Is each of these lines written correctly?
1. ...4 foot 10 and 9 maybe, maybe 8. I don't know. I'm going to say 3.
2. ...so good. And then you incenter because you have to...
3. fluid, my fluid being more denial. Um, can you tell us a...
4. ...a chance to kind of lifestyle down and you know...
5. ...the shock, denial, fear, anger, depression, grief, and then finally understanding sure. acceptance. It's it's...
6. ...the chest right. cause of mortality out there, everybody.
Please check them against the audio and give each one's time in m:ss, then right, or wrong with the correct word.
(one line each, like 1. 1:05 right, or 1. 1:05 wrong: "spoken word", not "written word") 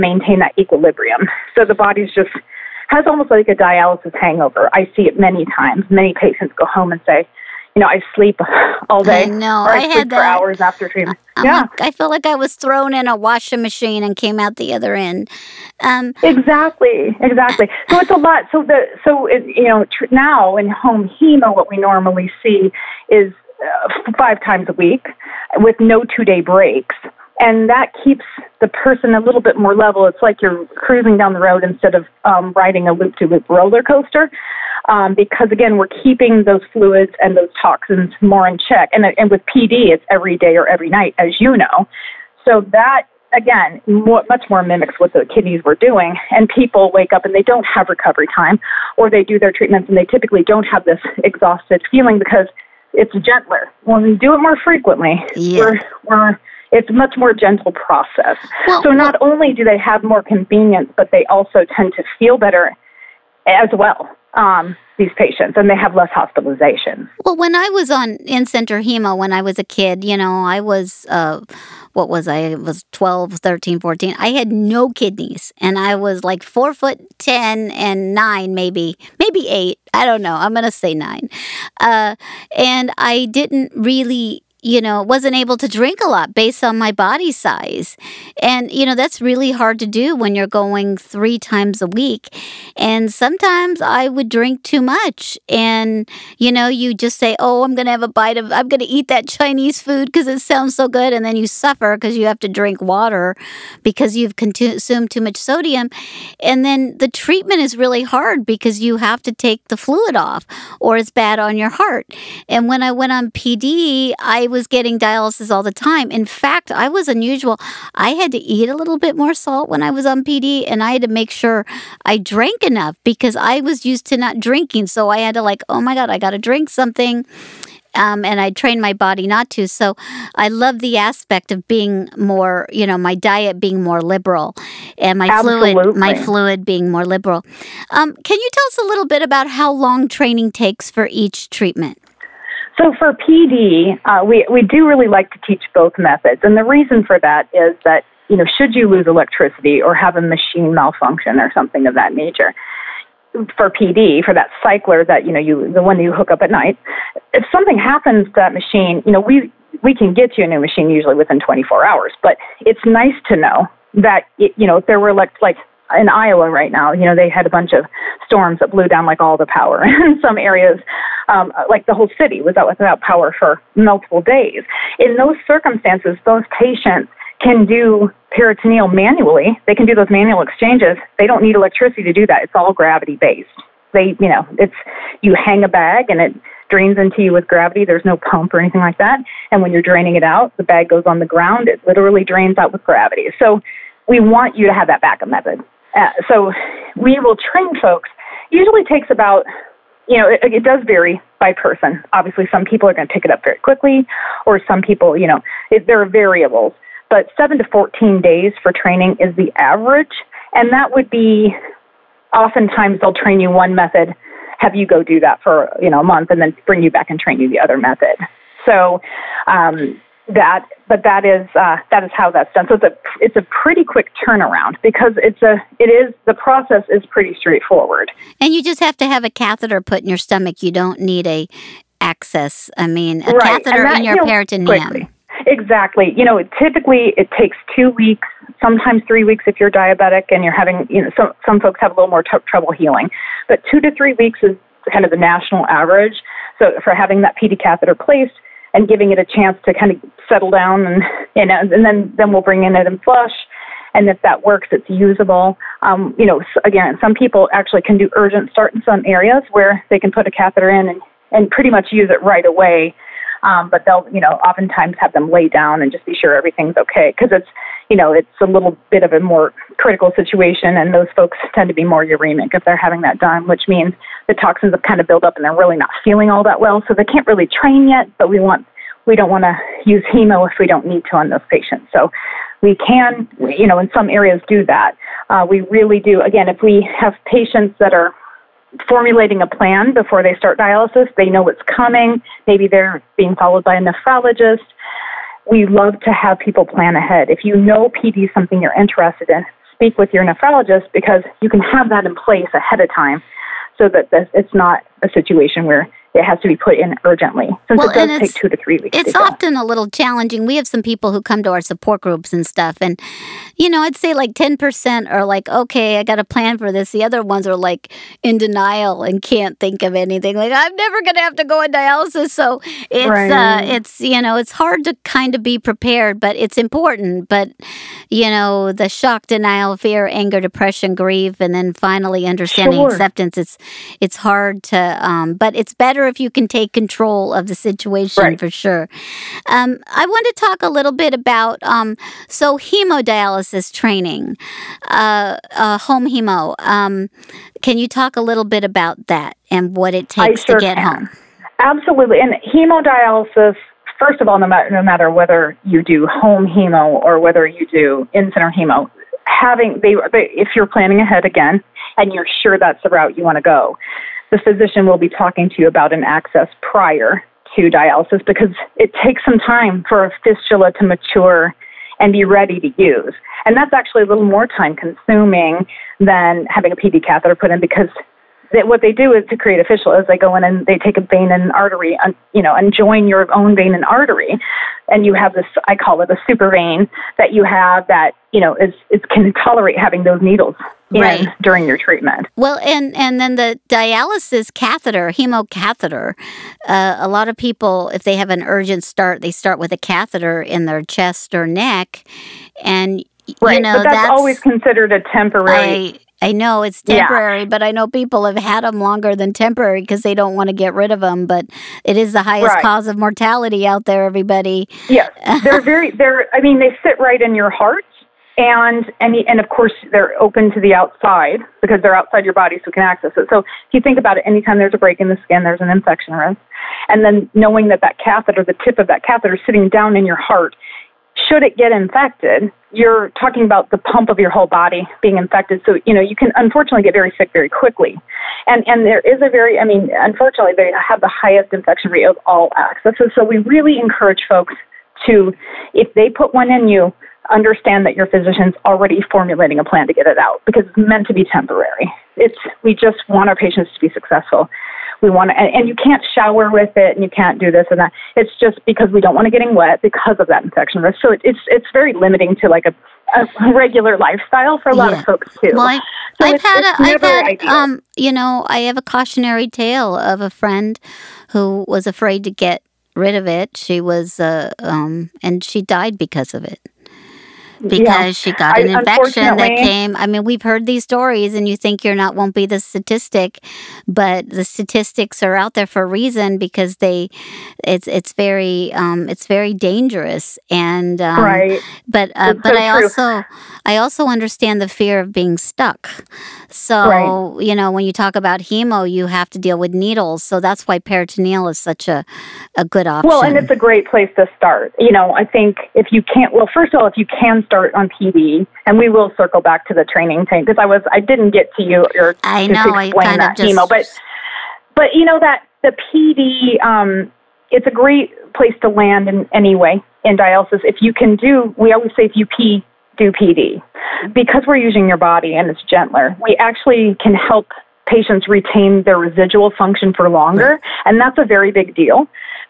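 1. 1:16 wrong: "9", not "3"
2. 1:40 wrong: "suffer", not "incenter"
3. 2:15 wrong: "liberal", not "denial"
4. 4:09 wrong: "settle", not "lifestyle"
5. 5:28 right
6. 6:52 wrong: "highest", not "chest".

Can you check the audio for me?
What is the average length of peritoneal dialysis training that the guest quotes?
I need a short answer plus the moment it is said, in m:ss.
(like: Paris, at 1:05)
7 to 14 days, at 3:27.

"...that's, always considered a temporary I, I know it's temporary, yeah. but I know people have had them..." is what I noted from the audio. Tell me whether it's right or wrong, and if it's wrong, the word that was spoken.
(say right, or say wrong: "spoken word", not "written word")
right.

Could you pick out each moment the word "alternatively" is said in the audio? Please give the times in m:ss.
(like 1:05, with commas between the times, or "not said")
not said.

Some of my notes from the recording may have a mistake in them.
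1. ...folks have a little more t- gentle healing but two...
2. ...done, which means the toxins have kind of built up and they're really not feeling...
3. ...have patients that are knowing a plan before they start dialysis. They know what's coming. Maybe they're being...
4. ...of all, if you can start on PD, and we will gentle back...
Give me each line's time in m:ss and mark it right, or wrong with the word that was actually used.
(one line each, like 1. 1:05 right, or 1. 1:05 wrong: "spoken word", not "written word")
1. 4:01 wrong: "trouble", not "gentle"
2. 4:33 right
3. 4:46 wrong: "formulating", not "knowing"
4. 8:26 wrong: "circle", not "gentle".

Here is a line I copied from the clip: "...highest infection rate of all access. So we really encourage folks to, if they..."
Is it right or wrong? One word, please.
right.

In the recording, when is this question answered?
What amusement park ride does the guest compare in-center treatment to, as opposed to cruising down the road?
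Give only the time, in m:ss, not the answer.
0:32.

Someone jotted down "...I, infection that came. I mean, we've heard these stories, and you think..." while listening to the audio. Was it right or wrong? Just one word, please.
right.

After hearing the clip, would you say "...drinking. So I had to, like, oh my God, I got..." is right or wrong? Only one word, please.
right.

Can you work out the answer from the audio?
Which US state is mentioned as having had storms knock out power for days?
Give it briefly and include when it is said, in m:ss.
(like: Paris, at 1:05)
Iowa, at 2:46.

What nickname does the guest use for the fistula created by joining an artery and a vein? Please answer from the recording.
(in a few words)
super vein.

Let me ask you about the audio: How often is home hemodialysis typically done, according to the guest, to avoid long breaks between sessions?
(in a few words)
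5 times a week.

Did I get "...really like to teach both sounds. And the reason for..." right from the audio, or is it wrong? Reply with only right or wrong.
wrong.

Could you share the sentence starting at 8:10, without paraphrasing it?
And um, right, but uh, but so I true.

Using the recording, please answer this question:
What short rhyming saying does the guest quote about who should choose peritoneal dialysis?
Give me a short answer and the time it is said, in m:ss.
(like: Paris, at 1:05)
If you pee, do PD, at 8:42.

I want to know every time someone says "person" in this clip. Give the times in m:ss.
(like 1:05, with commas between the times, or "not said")
0:28, 3:21.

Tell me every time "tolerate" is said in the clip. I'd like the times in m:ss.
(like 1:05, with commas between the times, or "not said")
6:29.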